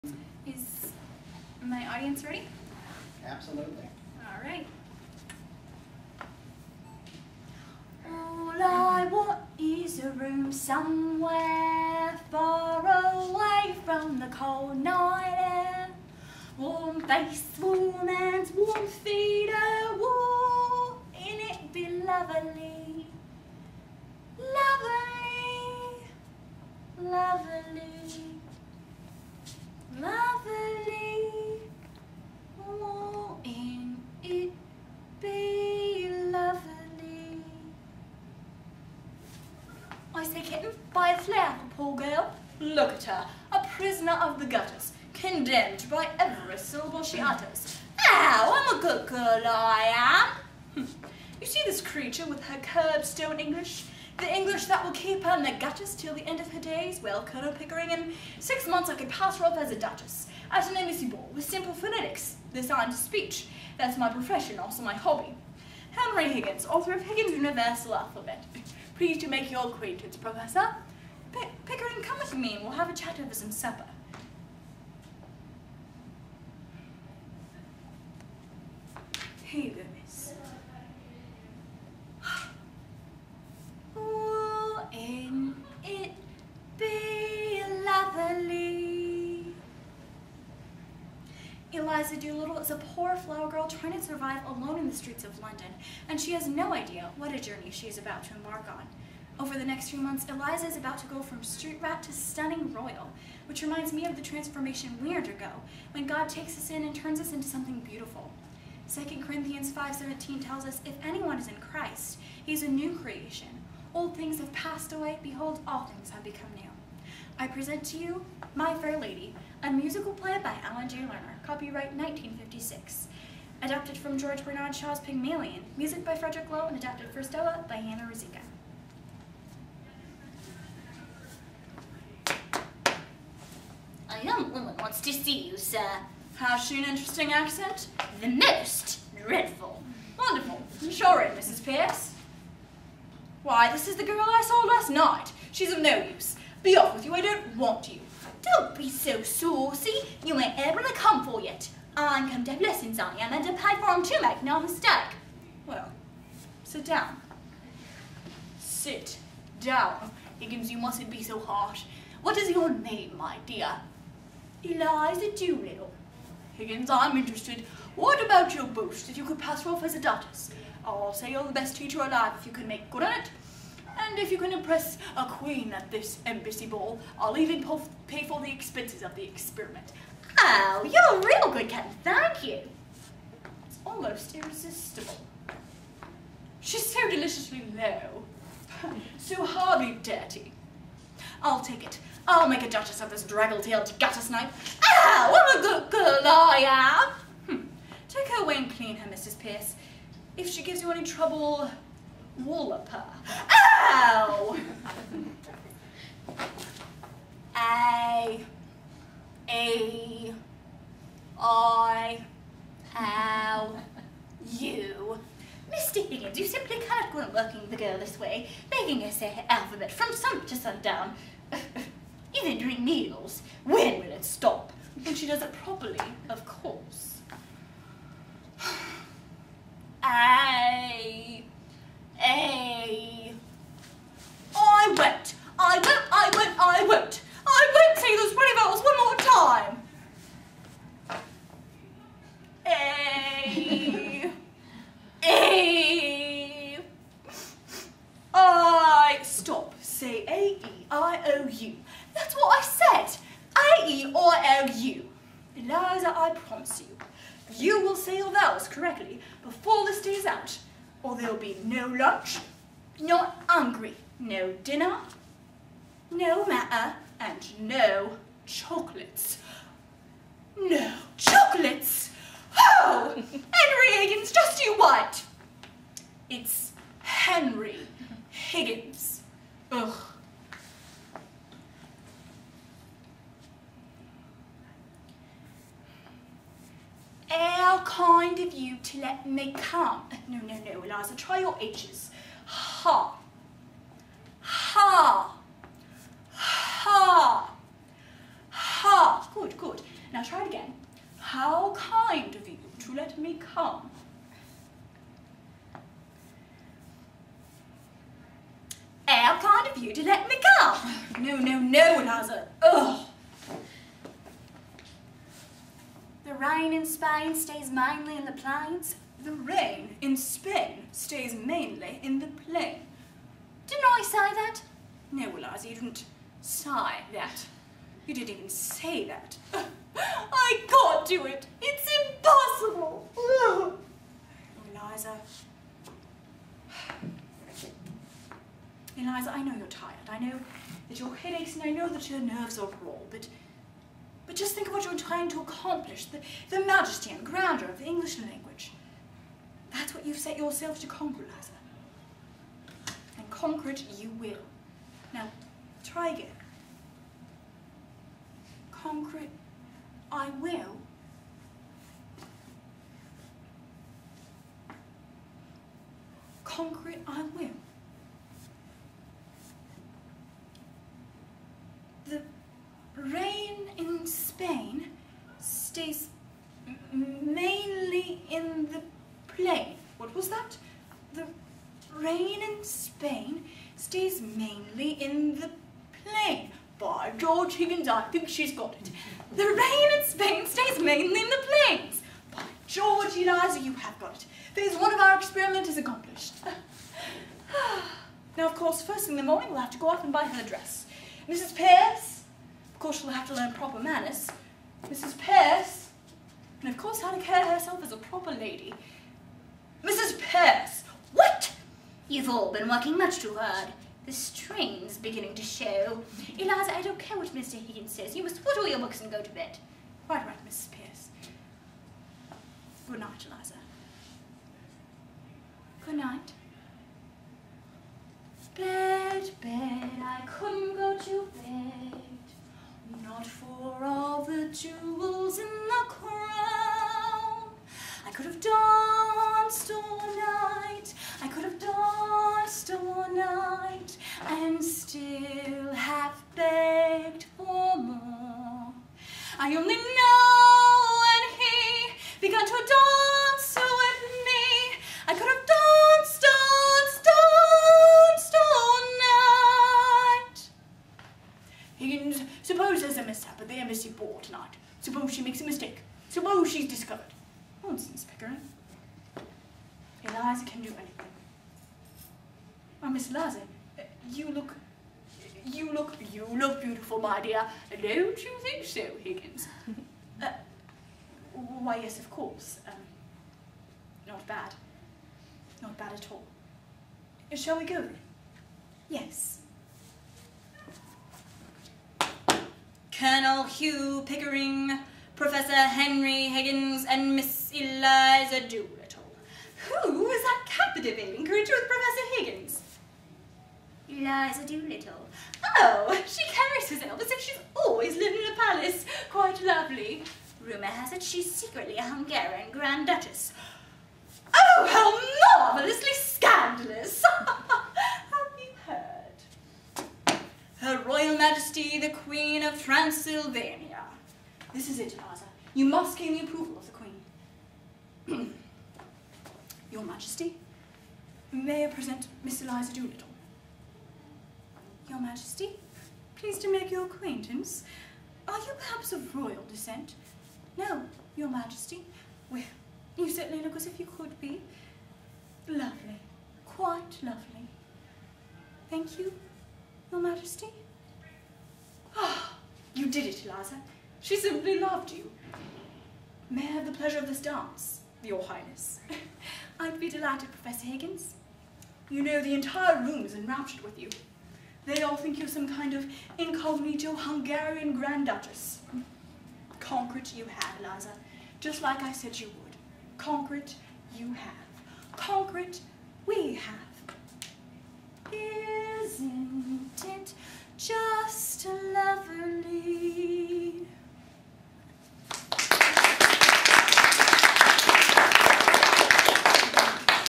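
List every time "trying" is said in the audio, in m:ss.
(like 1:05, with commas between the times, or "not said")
1:33, 5:44.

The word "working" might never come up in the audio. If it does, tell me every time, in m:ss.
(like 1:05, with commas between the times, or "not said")
3:37, 6:52.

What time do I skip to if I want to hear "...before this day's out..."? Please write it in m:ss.
4:19.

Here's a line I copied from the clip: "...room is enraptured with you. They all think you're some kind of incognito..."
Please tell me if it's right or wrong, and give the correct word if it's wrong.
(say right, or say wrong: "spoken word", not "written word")
right.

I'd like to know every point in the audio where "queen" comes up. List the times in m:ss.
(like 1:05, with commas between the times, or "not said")
2:55, 8:41, 8:46.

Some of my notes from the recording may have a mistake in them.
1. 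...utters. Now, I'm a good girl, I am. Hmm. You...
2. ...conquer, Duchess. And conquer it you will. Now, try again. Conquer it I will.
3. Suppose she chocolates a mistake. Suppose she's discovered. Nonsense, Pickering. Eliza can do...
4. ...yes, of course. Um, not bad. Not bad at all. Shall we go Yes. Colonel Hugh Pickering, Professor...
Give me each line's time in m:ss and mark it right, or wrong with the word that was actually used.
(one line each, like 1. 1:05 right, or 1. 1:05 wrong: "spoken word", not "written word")
1. 0:47 right
2. 5:50 wrong: "Liza", not "Duchess"
3. 7:44 wrong: "makes", not "chocolates"
4. 8:01 right.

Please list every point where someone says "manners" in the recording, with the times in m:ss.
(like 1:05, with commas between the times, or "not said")
6:43.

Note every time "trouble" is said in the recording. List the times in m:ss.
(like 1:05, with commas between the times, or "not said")
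3:21.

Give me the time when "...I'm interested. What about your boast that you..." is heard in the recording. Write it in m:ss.
2:46.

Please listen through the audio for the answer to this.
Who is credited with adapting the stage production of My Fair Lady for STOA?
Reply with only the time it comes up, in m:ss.
2:07.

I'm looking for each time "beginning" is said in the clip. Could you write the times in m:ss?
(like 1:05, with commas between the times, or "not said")
6:54.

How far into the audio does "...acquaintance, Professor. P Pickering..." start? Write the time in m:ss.
1:09.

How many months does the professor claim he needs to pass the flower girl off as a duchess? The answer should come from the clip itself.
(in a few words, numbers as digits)
6.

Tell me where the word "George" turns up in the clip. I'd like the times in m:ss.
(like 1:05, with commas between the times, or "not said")
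2:04, 6:27, 6:32.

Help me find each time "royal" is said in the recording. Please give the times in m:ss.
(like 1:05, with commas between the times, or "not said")
1:42, 8:59.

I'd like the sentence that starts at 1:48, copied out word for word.
2 Corinthians 5.17 tells us, if anyone is in Christ, he is a new creation.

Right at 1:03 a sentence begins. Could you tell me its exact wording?
That's my profession, also my hobby.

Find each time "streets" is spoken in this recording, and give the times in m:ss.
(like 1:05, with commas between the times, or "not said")
1:34, 1:41.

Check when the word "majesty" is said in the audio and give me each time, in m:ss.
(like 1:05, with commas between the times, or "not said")
5:46, 8:41, 8:49, 8:55, 9:01, 9:09.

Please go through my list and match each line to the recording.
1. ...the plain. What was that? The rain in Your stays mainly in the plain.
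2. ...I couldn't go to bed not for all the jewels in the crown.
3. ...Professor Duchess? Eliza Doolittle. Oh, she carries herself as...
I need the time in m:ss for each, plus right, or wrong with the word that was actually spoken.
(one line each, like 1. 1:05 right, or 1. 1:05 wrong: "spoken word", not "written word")
1. 6:18 wrong: "Spain", not "Your"
2. 7:10 right
3. 8:21 wrong: "Higgins", not "Duchess".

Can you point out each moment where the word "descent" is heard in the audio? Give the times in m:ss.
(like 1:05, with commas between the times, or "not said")
8:59.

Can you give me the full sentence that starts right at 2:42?
What is your name, my dear?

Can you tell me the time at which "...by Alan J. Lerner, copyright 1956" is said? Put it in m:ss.
2:00.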